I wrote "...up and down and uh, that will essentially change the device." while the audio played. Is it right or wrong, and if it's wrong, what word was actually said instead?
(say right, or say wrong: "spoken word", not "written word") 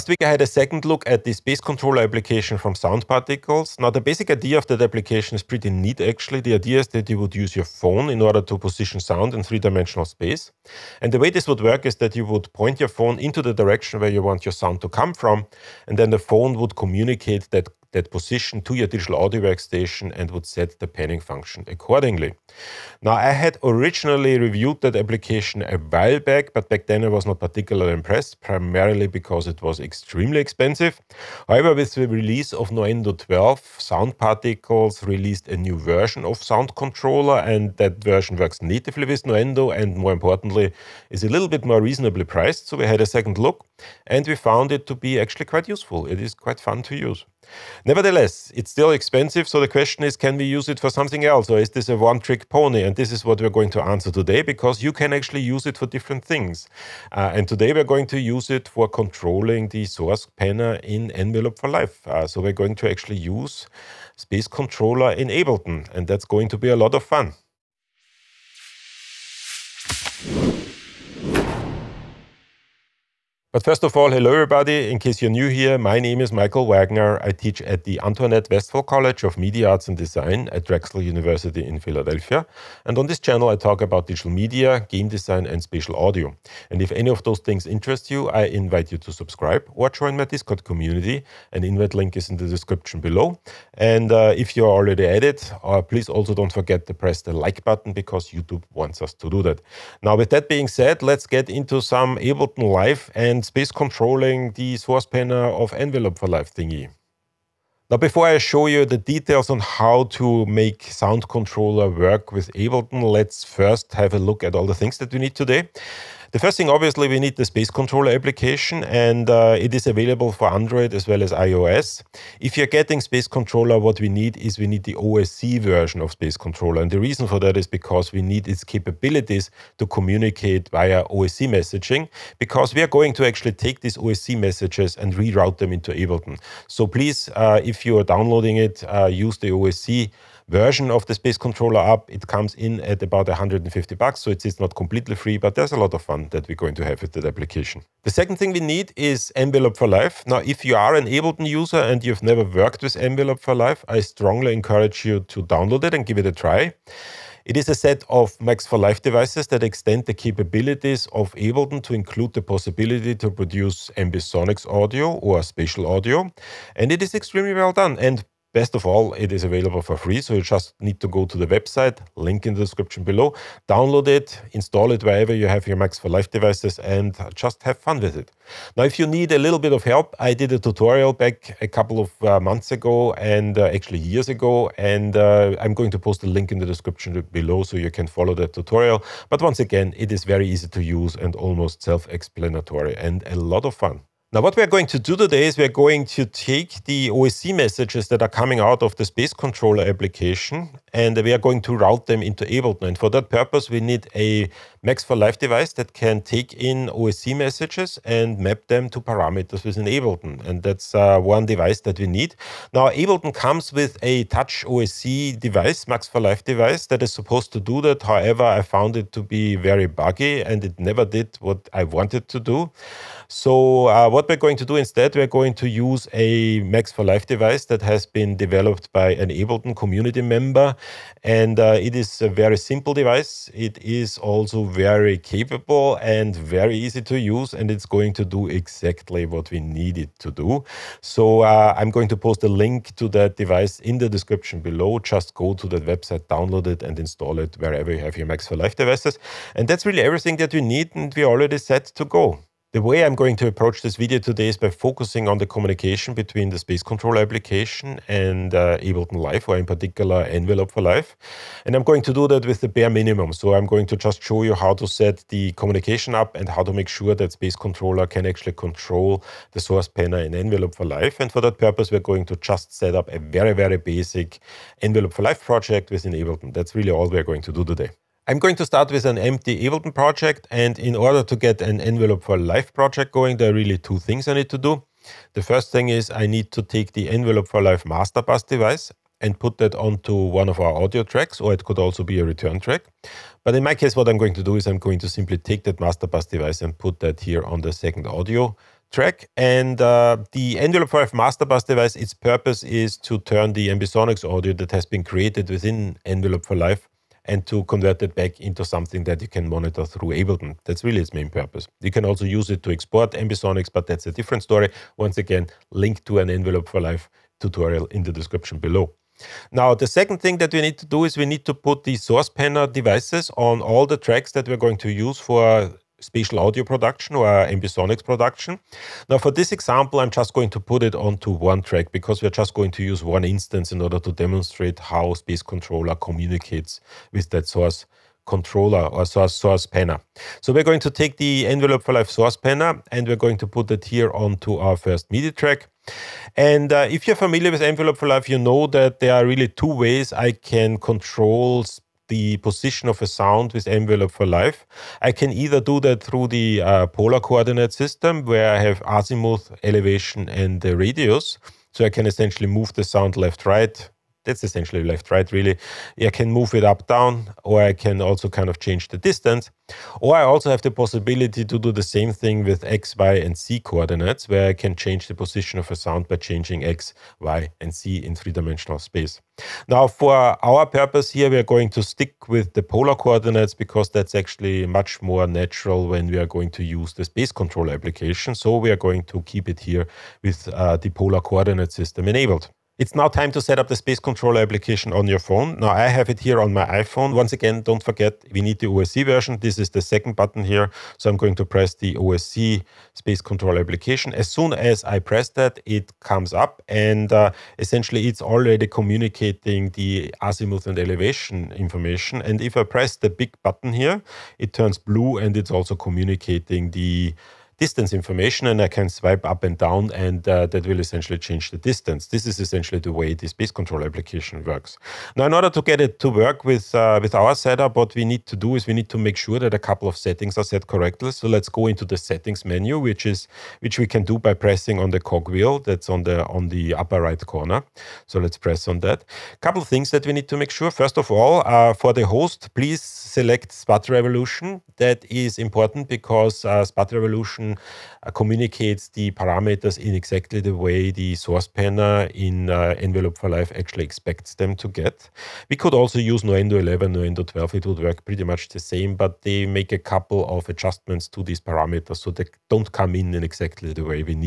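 wrong: "distance", not "device".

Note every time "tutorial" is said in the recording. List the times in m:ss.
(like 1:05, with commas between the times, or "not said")
3:00, 3:08, 5:17.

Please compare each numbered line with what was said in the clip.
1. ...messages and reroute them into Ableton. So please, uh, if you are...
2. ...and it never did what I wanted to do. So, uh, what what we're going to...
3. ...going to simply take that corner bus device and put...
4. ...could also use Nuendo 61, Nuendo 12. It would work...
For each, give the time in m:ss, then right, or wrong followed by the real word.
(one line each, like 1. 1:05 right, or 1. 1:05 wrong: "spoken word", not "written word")
1. 2:14 right
2. 3:40 right
3. 4:54 wrong: "master", not "corner"
4. 7:35 wrong: "11", not "61".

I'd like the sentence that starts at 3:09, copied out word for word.
But once again, it is very easy to use and almost self explanatory and a lot of fun.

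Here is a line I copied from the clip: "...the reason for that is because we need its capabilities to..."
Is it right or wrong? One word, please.
right.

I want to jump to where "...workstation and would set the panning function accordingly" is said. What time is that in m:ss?
0:19.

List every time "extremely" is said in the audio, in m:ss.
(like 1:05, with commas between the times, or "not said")
0:29, 2:47.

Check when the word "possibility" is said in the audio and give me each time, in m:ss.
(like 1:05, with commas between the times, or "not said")
2:42, 6:10.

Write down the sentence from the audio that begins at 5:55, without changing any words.
I can either do that through the uh, polar coordinate system where I have azimuth, elevation, and the radius.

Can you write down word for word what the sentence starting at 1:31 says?
An invite link is in the description below.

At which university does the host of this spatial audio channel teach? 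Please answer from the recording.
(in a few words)
Drexel University.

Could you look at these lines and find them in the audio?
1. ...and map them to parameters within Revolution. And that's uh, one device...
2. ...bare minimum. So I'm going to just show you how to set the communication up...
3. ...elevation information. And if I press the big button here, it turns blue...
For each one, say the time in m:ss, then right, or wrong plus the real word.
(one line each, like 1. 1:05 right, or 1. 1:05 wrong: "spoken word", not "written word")
1. 3:28 wrong: "Ableton", not "Revolution"
2. 4:22 right
3. 6:50 right.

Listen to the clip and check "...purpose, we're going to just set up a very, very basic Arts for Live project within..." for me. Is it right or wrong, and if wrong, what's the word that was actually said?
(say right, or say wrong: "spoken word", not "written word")
wrong: "Envelop", not "Arts".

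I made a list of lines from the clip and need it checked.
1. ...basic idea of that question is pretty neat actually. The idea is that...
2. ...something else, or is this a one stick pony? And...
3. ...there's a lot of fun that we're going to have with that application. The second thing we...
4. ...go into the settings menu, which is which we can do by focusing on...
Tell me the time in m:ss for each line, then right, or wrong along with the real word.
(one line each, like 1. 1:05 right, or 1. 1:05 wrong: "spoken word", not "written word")
1. 0:03 wrong: "application", not "question"
2. 0:50 wrong: "trick", not "stick"
3. 2:25 right
4. 7:11 wrong: "pressing", not "focusing".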